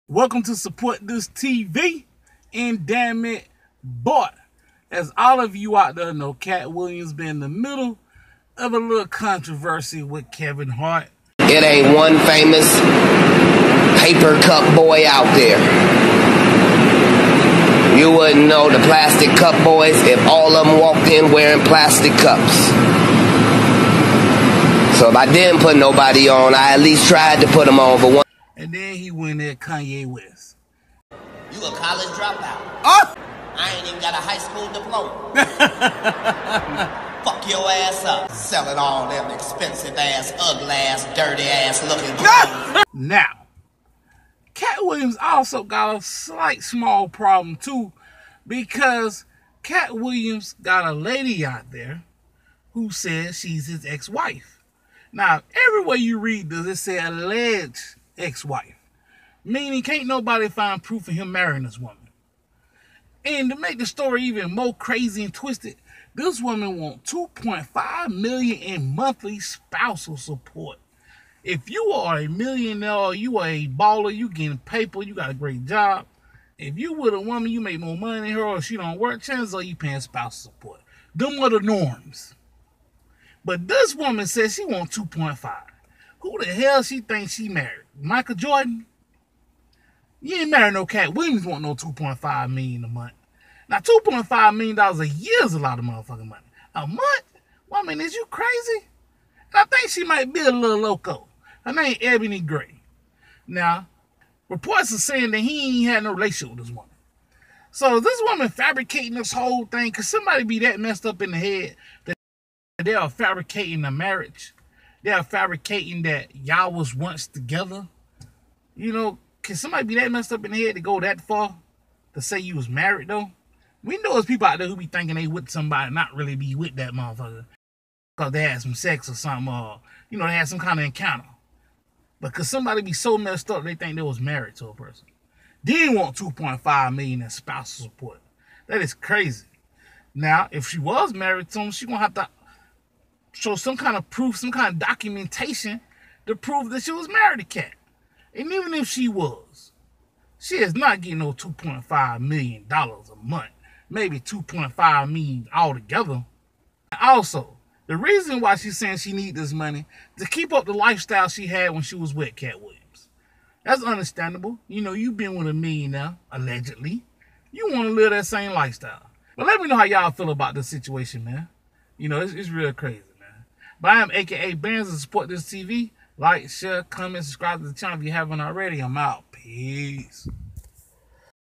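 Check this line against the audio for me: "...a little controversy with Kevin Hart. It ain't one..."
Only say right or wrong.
right.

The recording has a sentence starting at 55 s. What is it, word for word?
Now, everywhere you read does it say alleged ex-wife.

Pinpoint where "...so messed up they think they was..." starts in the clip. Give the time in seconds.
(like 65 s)
132 s.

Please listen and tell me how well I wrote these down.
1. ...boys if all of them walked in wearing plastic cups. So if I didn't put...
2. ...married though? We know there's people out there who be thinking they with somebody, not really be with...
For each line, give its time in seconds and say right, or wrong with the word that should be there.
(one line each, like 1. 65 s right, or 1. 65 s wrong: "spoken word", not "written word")
1. 19 s right
2. 122 s right.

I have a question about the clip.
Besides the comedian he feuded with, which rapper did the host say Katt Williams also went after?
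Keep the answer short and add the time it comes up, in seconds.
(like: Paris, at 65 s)
Kanye West, at 29 s.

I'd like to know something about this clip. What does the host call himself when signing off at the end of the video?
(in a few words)
Bands.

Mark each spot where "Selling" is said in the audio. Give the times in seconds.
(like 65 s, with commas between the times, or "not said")
38 s.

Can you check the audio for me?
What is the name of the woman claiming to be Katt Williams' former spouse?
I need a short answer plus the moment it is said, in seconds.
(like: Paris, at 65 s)
Ebony Gray, at 102 s.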